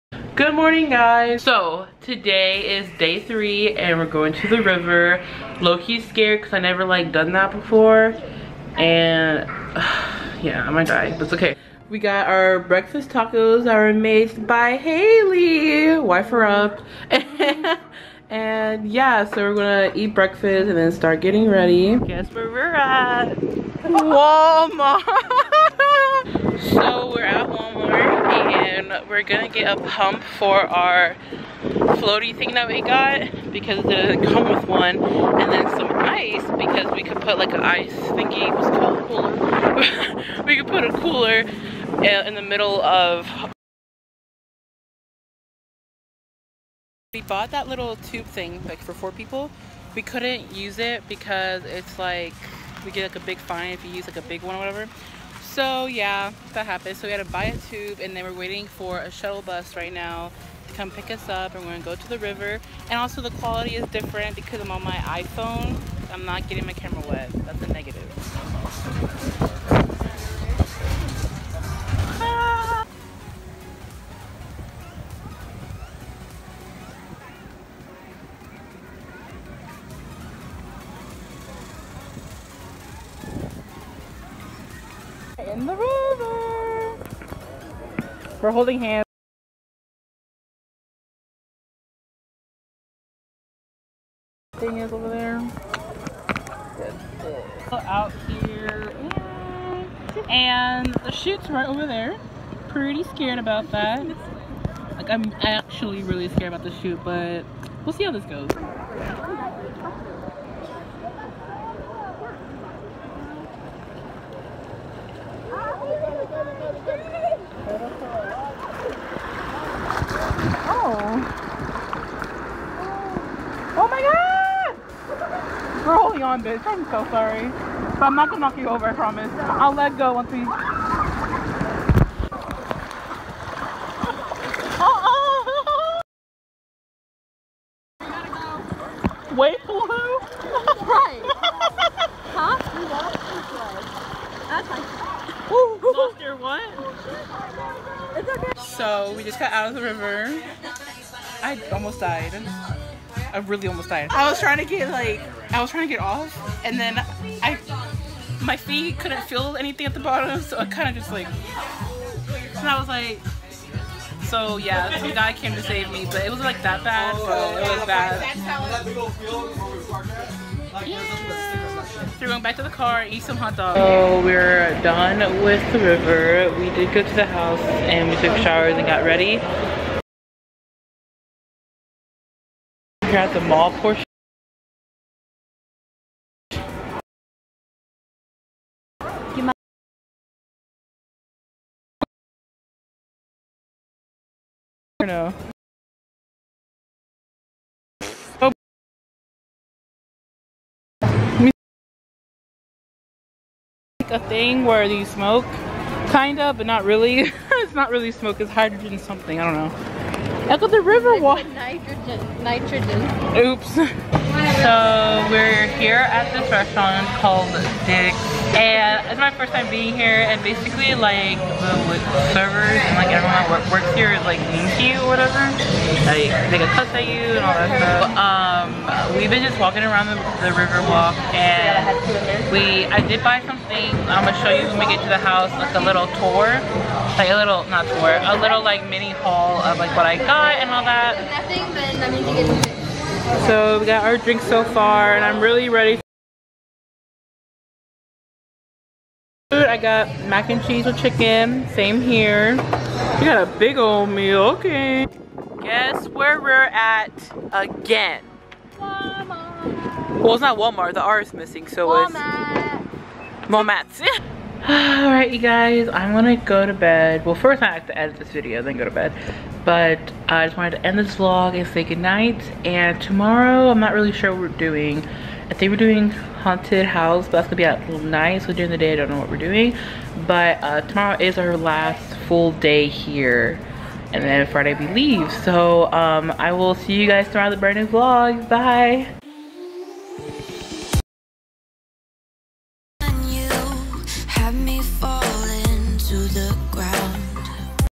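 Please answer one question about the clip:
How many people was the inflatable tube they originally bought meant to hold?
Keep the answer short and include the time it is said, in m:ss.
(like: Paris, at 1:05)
4, at 0:48.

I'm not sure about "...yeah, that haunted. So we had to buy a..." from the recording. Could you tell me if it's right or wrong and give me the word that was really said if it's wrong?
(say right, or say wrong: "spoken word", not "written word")
wrong: "happened", not "haunted".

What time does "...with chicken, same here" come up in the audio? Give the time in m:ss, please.
4:10.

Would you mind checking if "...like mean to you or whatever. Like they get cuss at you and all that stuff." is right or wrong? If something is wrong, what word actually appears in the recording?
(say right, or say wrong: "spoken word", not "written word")
right.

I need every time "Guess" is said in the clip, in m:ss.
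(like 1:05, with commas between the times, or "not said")
0:21, 4:15.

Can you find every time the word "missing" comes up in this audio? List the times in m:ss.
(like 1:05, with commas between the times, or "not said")
4:21.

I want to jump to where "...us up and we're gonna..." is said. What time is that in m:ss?
1:01.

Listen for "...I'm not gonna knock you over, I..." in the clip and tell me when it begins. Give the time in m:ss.
2:08.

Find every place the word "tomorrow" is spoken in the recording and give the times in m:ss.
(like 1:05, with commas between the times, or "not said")
4:33, 4:40, 4:47.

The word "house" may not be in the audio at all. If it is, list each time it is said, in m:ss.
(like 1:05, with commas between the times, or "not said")
2:57, 3:55, 4:36.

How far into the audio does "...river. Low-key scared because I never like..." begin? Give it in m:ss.
0:04.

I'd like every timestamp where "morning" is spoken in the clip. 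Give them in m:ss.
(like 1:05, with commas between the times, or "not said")
0:00.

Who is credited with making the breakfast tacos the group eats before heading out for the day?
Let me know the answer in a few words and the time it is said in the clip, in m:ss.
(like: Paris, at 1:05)
Haley, at 0:14.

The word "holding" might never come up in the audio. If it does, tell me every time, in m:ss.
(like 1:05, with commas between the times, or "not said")
1:28, 2:05.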